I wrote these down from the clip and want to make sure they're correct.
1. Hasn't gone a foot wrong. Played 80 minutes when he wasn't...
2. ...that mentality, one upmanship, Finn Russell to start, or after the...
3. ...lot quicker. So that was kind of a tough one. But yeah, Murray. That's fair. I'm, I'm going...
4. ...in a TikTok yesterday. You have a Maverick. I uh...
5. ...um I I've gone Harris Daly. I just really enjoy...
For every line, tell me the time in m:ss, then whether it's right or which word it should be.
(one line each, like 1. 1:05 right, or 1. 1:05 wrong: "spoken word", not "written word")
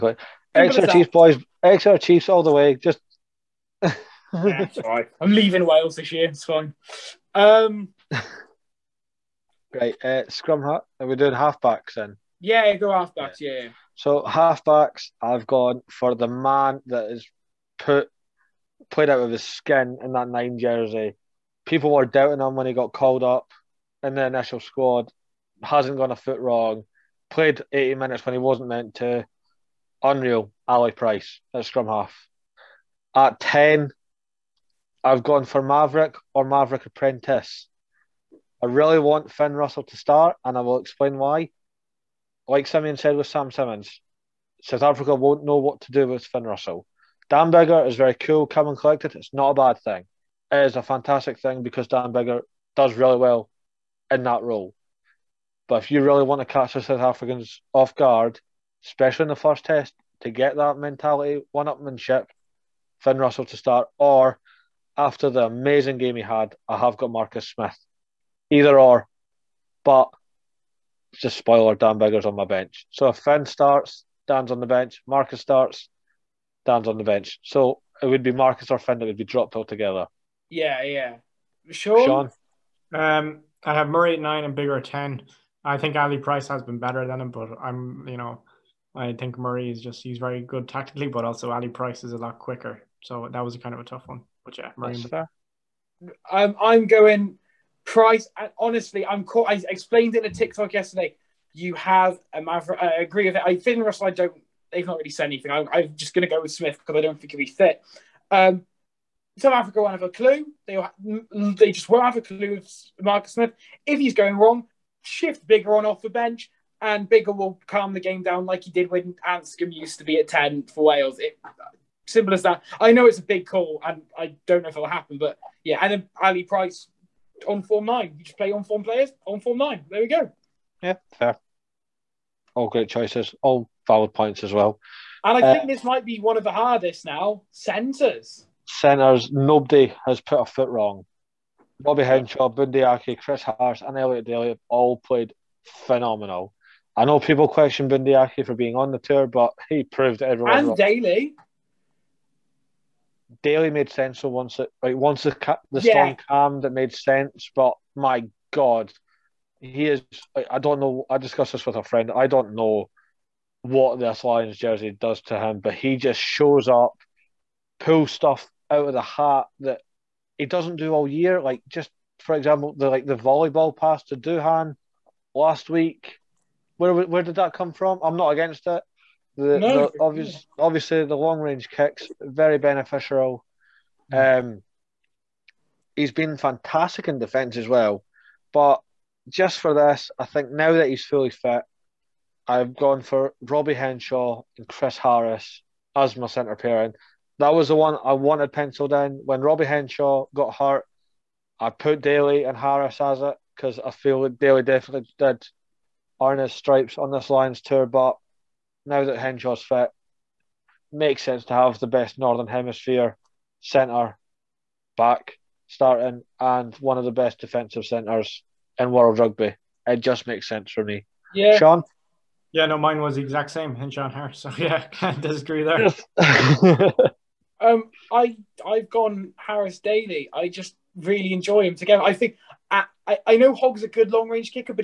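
1. 0:25 right
2. 1:00 right
3. 1:32 right
4. 1:40 right
5. 3:47 right.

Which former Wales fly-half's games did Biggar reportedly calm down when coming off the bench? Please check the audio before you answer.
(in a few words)
Anscombe.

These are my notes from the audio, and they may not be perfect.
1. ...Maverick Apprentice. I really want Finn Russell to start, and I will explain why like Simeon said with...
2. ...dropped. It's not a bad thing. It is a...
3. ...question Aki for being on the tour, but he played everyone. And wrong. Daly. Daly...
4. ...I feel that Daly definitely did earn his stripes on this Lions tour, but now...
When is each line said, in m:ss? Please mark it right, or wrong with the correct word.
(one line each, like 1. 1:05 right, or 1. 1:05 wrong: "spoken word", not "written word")
1. 0:36 right
2. 0:48 wrong: "collected", not "dropped"
3. 2:27 wrong: "proved", not "played"
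4. 3:23 right.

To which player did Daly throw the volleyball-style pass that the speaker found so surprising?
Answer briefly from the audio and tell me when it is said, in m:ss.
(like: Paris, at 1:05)
Duhan, at 2:54.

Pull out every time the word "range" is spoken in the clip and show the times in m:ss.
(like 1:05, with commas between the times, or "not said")
3:01, 3:54.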